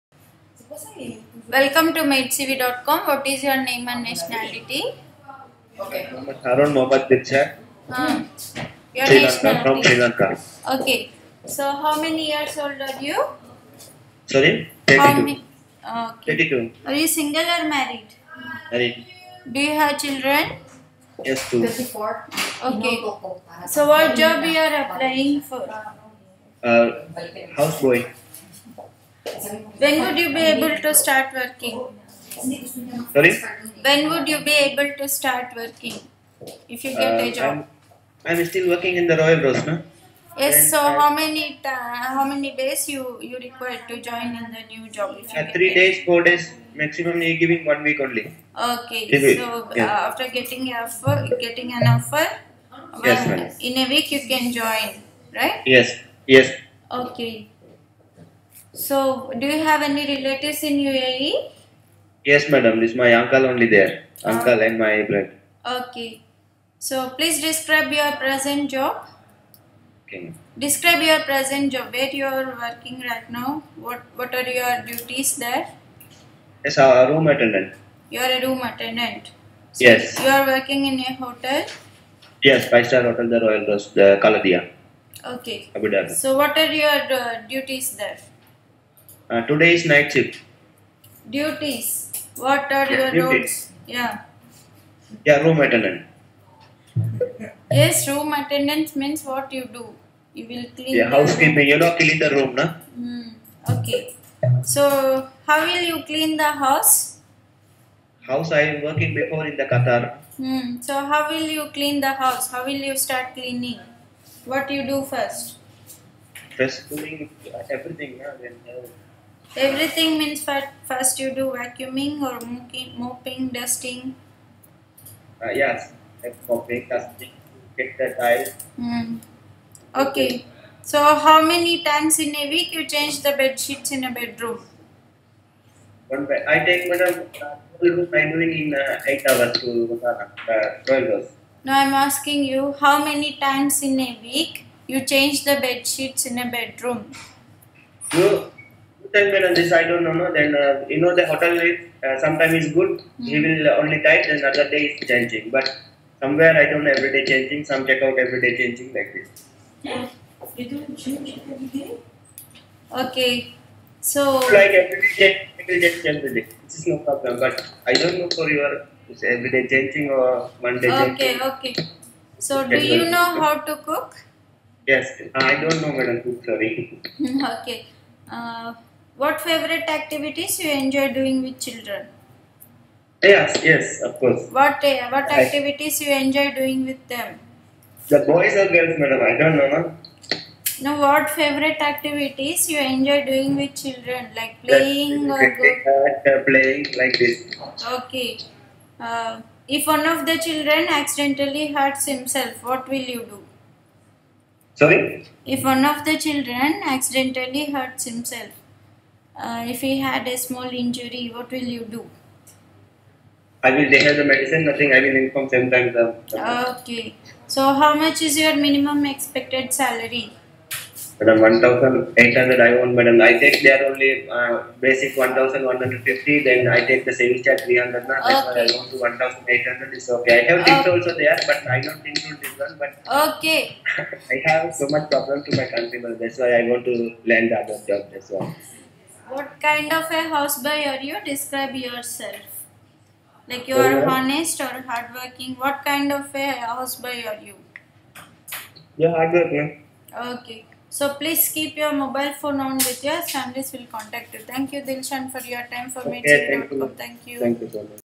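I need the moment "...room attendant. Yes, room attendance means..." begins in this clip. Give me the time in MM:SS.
01:35.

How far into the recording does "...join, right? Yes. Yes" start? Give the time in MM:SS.
00:54.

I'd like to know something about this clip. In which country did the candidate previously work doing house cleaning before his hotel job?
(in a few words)
Qatar.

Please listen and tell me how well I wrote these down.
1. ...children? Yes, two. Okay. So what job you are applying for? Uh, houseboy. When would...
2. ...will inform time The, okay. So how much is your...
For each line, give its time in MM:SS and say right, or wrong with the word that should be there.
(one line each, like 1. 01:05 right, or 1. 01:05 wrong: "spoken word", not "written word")
1. 00:19 right
2. 03:34 right.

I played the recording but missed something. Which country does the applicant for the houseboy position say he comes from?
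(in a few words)
Sri Lanka.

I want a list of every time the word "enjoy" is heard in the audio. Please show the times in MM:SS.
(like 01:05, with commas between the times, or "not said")
03:00, 03:06, 03:12.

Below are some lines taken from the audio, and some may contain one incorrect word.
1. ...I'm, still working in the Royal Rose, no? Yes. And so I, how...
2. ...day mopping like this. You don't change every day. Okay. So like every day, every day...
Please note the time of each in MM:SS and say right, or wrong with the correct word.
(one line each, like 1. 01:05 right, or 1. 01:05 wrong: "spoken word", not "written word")
1. 00:38 right
2. 02:38 wrong: "changing", not "mopping".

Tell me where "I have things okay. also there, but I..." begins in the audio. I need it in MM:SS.
03:50.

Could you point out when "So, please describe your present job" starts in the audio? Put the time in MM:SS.
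01:06.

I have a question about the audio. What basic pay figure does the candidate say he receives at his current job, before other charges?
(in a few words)
1,150.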